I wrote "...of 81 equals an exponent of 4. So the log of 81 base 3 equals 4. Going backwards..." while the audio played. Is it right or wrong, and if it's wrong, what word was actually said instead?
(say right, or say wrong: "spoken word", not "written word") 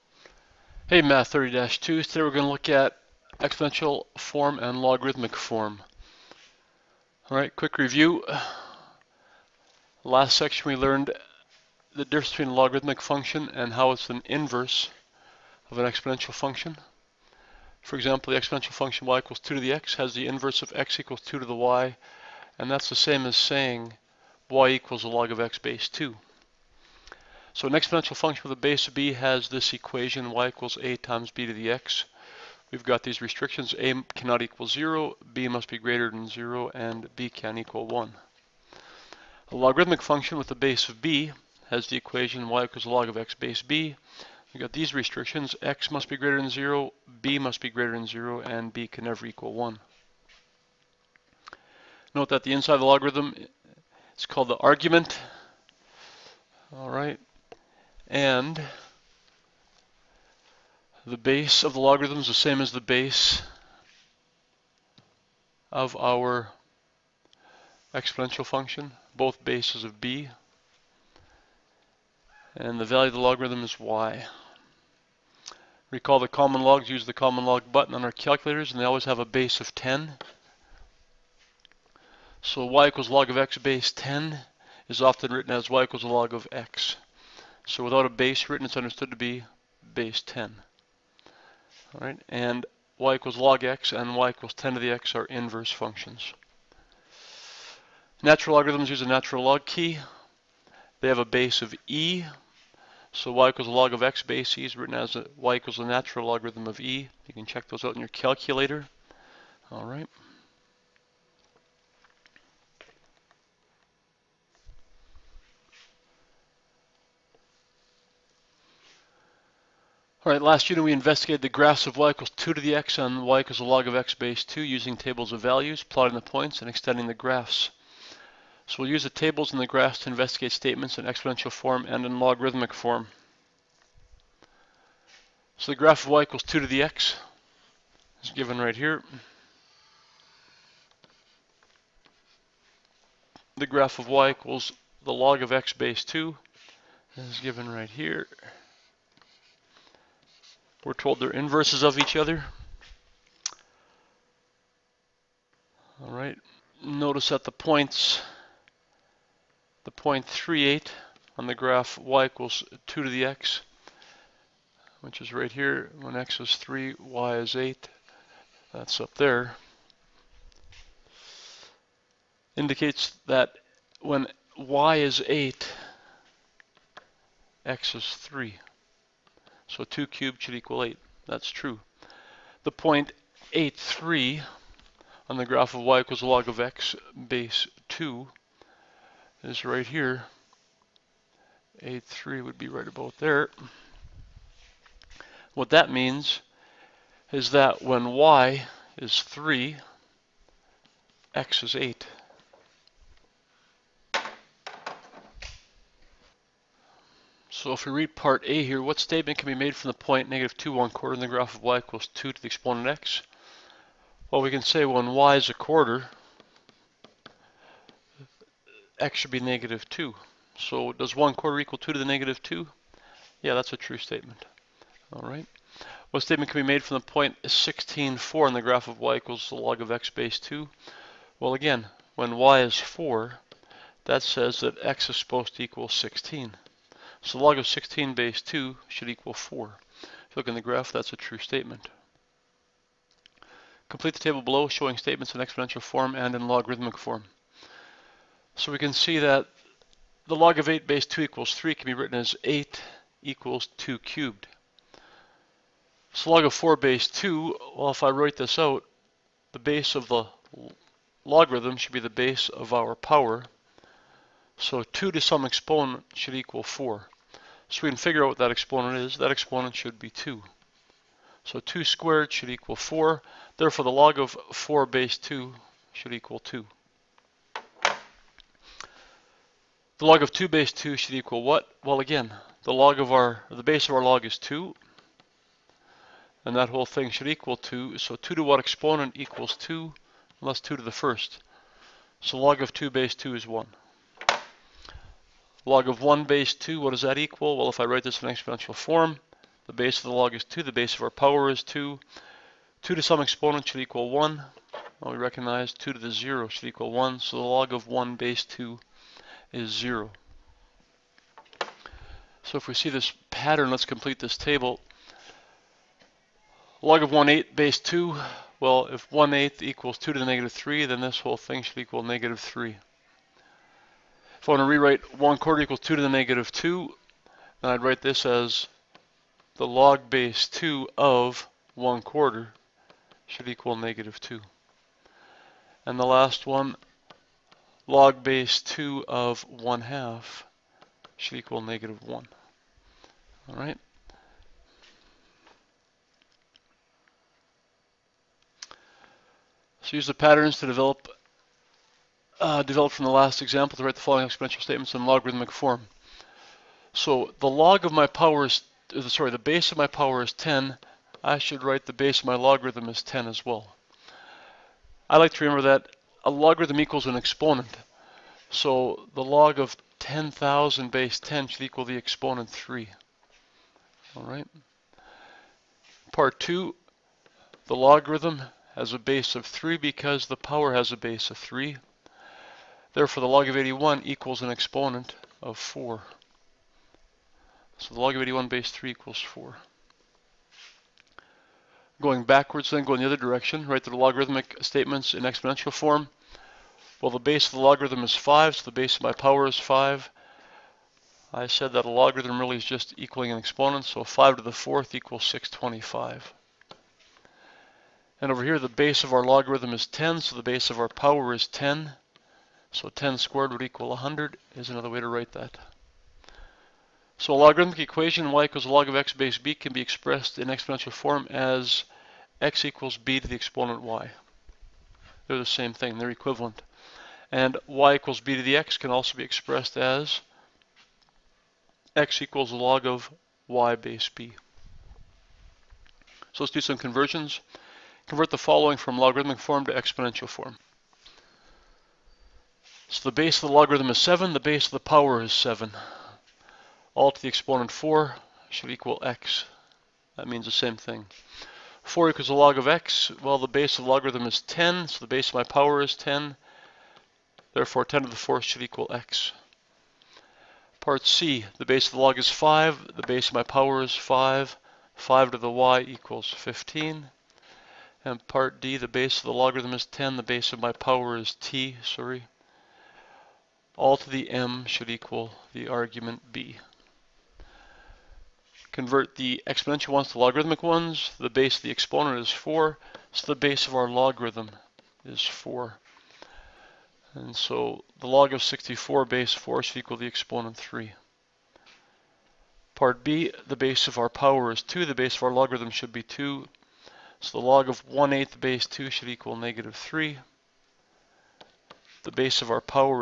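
right.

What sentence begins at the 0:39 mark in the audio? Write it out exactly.
A logarithmic function with a base of b has the equation y equals log of x base b.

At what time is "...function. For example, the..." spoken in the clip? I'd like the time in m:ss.
0:16.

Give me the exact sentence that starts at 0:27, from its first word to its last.
So an exponential function with a base of b has this equation y equals a times b to the x.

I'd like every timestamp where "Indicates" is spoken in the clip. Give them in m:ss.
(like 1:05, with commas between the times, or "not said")
2:52.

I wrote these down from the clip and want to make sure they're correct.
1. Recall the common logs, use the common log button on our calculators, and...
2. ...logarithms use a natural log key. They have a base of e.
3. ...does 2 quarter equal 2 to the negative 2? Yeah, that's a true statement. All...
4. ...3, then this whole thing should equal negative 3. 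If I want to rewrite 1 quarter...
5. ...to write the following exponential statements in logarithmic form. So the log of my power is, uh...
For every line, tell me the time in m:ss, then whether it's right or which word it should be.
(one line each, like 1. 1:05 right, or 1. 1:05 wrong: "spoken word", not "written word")
1. 1:15 right
2. 1:38 right
3. 3:40 wrong: "1", not "2"
4. 5:20 right
5. 5:53 right.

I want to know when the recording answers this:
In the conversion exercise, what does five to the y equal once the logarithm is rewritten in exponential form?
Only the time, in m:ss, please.
7:46.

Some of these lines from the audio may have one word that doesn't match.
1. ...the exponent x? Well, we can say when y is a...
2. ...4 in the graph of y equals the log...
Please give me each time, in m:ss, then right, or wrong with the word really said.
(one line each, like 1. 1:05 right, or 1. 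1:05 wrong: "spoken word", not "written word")
1. 3:32 right
2. 3:48 right.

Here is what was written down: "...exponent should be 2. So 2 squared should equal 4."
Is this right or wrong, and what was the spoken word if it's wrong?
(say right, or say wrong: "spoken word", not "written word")
right.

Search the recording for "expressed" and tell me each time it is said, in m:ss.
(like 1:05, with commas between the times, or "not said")
6:59, 7:09.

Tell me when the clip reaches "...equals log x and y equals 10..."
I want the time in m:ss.
1:33.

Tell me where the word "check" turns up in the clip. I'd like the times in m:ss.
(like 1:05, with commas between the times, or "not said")
1:47.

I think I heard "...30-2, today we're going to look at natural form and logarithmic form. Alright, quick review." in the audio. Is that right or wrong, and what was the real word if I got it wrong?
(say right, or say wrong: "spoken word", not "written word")
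wrong: "exponential", not "natural".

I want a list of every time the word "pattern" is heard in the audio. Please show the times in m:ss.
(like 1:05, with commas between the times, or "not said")
5:13, 5:50.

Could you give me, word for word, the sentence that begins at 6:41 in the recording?
I said that a logarithm really is just equaling an exponent, so 5 to the 4th equals 625.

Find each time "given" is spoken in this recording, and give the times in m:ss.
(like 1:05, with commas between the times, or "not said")
2:18, 2:27.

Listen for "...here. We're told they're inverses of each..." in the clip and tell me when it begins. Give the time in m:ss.
2:27.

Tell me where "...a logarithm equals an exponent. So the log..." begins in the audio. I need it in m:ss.
6:06.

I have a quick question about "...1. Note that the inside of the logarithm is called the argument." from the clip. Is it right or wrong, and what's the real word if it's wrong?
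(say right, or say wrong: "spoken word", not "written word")
right.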